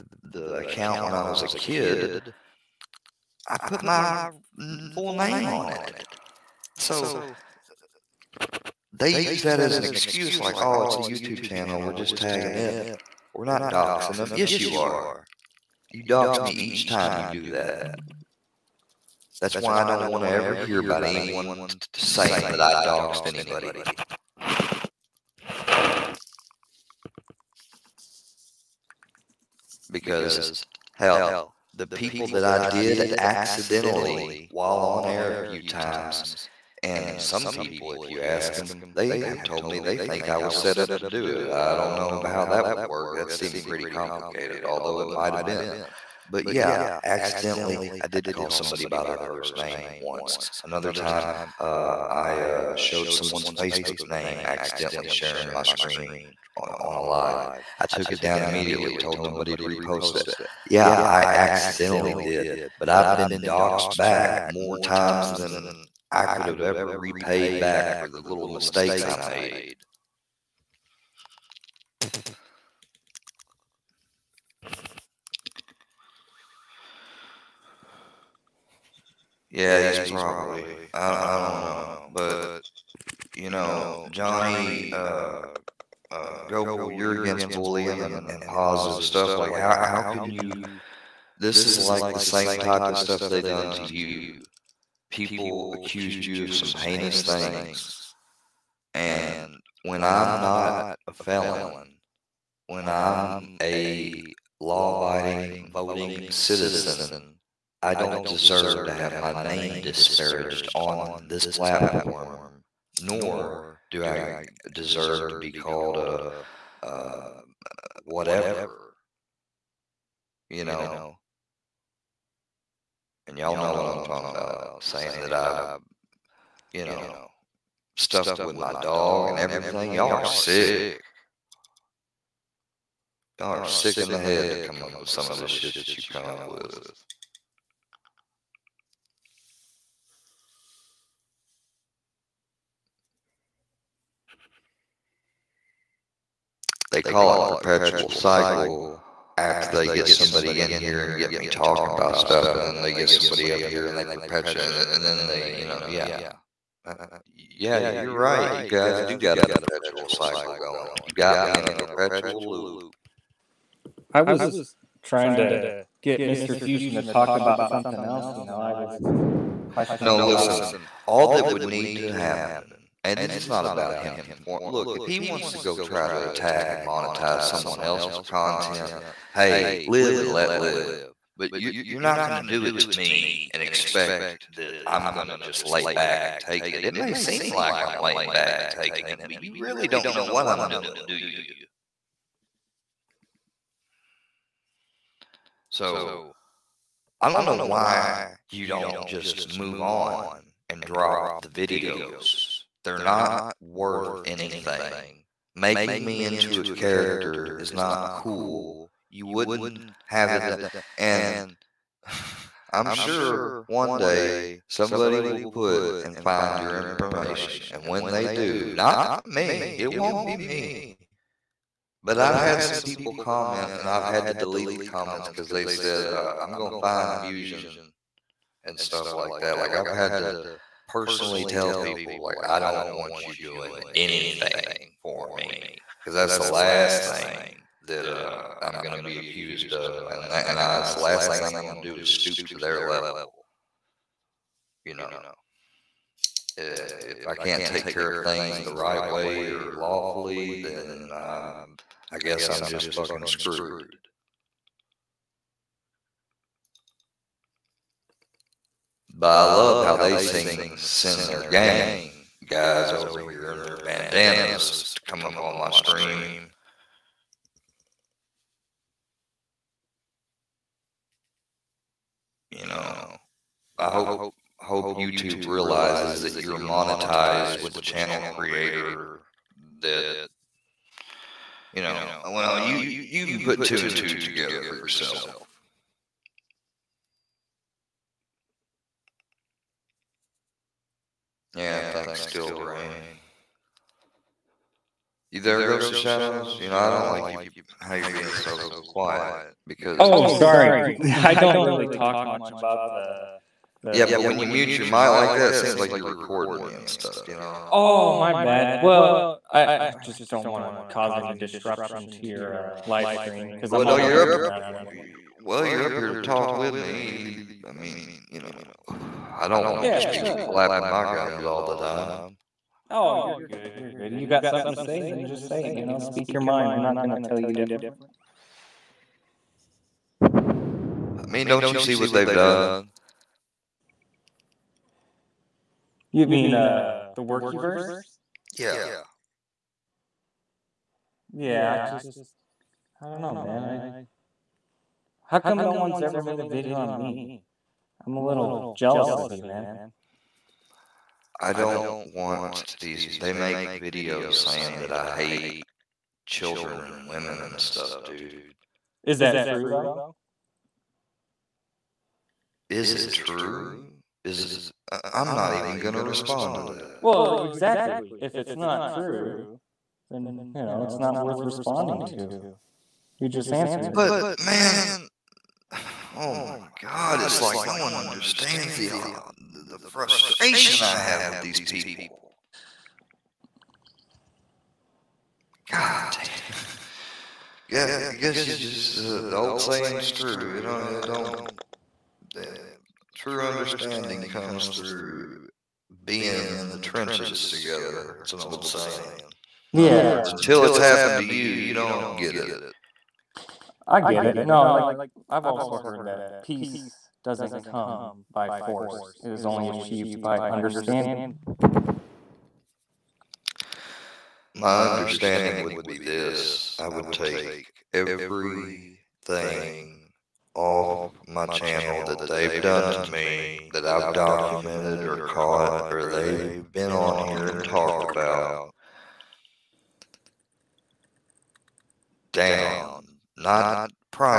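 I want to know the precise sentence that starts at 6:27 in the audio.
Yeah, I guess you just uh, the old saying's true.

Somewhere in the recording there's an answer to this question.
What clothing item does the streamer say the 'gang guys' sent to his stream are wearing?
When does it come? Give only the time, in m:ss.
4:23.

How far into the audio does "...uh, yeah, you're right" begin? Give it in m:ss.
2:36.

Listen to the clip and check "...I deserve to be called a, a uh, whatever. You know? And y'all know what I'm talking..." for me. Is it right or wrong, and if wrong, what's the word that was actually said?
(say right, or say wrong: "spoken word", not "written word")
right.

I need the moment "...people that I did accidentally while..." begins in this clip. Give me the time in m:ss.
0:31.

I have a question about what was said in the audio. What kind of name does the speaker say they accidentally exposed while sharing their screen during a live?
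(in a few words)
Facebook name.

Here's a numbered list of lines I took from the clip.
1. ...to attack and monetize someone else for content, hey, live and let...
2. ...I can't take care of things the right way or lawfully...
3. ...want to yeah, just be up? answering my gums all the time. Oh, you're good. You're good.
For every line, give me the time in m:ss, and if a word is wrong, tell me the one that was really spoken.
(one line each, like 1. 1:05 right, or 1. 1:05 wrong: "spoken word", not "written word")
1. 2:56 right
2. 4:07 right
3. 5:19 wrong: "flapping", not "answering".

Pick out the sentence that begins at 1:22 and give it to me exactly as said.
But, you know, Johnny uh, uh, Goble, you're against bullying and, and positive stuff.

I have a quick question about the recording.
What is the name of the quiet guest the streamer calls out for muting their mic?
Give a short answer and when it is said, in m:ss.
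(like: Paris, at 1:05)
Ghost of shadows, at 4:55.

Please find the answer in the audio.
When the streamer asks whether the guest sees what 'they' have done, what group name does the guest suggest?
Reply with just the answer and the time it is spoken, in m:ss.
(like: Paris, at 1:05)
the Workiverse, at 5:37.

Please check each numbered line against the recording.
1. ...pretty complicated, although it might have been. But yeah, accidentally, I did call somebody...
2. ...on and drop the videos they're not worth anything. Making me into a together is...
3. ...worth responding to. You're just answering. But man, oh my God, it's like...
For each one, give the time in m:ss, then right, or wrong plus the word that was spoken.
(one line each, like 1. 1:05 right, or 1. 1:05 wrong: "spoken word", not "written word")
1. 0:43 right
2. 3:19 wrong: "character", not "together"
3. 6:11 right.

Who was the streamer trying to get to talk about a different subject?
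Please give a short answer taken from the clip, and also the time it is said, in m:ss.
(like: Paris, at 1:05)
Mister Fusion, at 2:46.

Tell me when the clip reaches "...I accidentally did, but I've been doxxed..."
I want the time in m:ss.
1:01.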